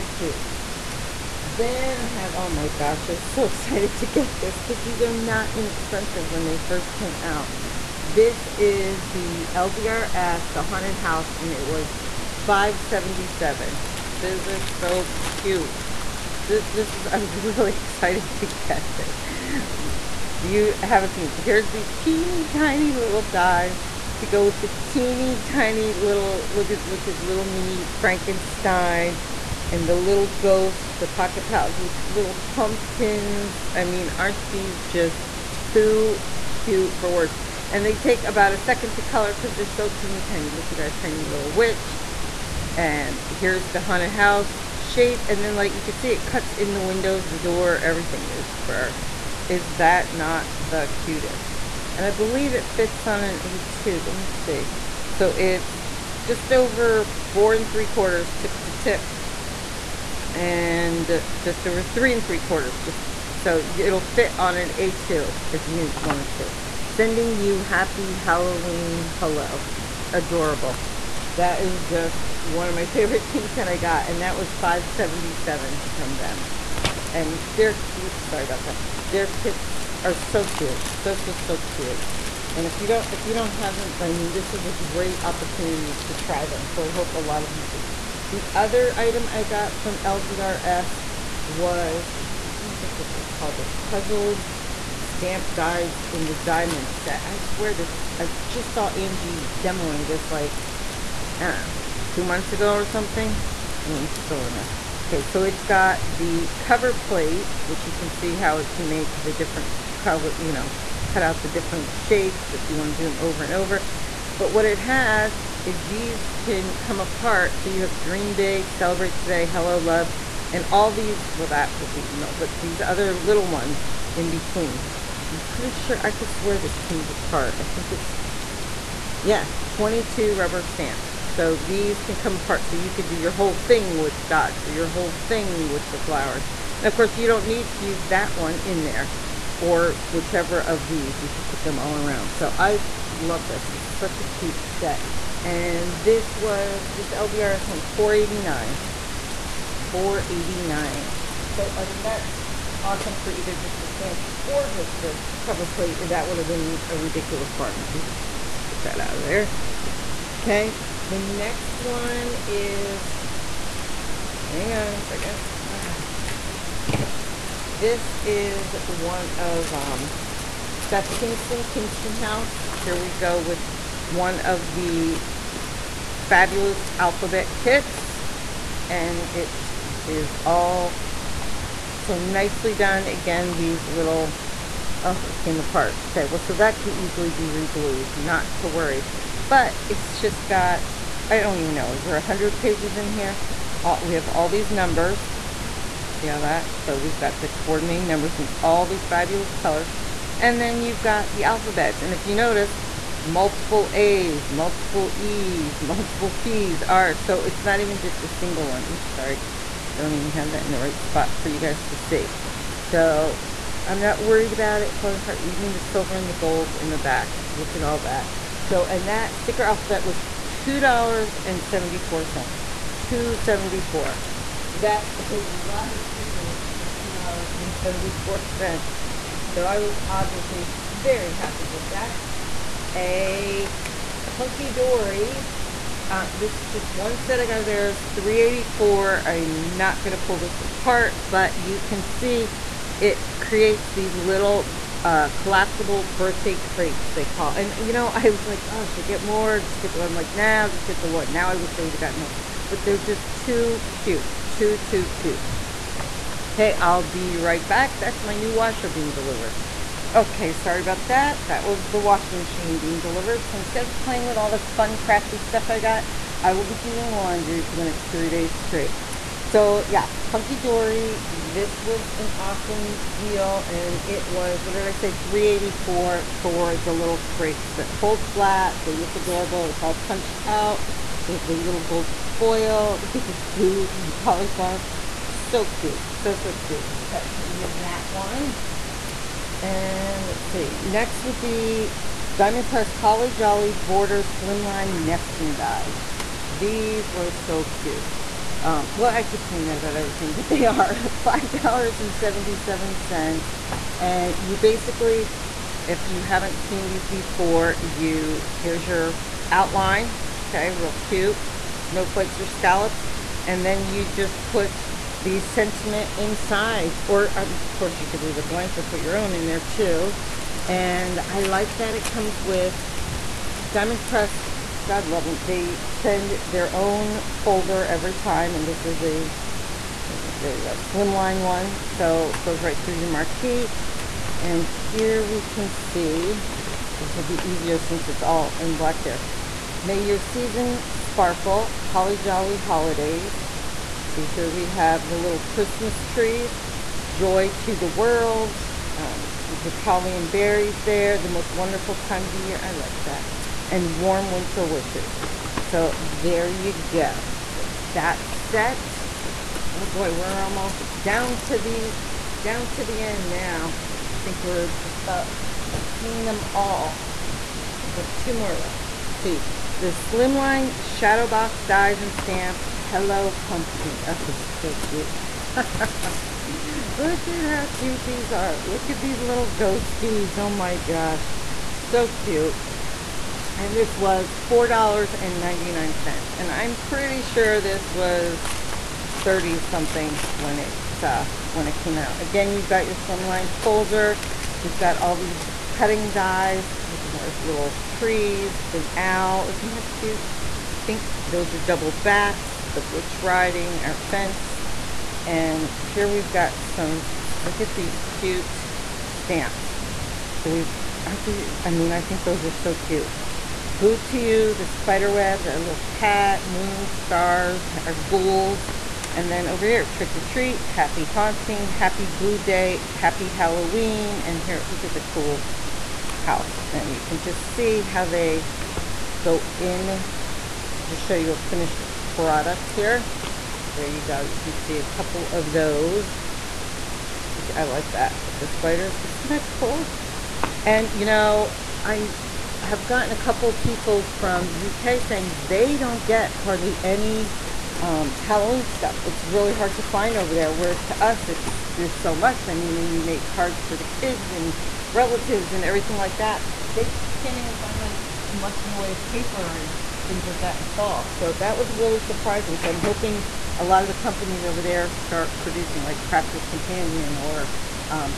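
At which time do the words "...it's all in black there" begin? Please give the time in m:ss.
5:38.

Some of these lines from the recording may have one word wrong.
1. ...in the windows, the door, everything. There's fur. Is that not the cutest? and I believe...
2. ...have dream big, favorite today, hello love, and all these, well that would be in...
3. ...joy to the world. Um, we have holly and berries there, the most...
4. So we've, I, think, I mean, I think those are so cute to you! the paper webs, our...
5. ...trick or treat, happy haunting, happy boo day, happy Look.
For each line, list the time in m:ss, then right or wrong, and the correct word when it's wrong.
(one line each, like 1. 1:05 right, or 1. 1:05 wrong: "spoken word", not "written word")
1. 0:46 right
2. 1:57 wrong: "celebrate", not "favorite"
3. 5:47 right
4. 6:50 wrong: "spider", not "paper"
5. 6:59 wrong: "Halloween", not "Look".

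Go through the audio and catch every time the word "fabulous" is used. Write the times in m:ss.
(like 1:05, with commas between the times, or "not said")
2:56, 3:19.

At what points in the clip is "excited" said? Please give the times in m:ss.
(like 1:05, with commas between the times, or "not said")
0:03, 0:17.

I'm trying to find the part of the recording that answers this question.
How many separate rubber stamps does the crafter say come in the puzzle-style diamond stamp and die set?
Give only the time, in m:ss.
2:09.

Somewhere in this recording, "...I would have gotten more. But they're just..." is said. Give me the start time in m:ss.
4:11.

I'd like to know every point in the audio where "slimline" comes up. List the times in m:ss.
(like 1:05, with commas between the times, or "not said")
4:54, 5:30, 6:09, 6:32.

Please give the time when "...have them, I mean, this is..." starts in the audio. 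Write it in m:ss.
1:23.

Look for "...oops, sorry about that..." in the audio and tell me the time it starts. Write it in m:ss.
1:17.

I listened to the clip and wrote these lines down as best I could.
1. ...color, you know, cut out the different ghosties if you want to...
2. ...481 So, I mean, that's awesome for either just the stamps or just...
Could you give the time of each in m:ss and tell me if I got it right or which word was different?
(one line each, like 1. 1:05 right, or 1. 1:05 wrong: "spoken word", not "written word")
1. 1:49 wrong: "shapes", not "ghosties"
2. 2:29 wrong: "489", not "481".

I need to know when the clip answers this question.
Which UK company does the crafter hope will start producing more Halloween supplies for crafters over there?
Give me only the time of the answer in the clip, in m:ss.
7:46.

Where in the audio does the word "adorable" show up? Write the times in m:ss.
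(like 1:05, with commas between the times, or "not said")
1:10, 4:39.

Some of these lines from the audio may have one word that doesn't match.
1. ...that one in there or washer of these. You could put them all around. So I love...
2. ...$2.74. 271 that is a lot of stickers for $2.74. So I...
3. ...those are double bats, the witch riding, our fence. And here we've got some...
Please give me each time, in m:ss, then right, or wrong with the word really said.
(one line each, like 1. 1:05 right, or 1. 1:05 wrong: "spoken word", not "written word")
1. 2:18 wrong: "whichever", not "washer"
2. 3:40 wrong: "274", not "271"
3. 6:41 right.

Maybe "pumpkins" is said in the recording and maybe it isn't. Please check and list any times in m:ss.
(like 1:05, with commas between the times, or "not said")
0:32, 6:13.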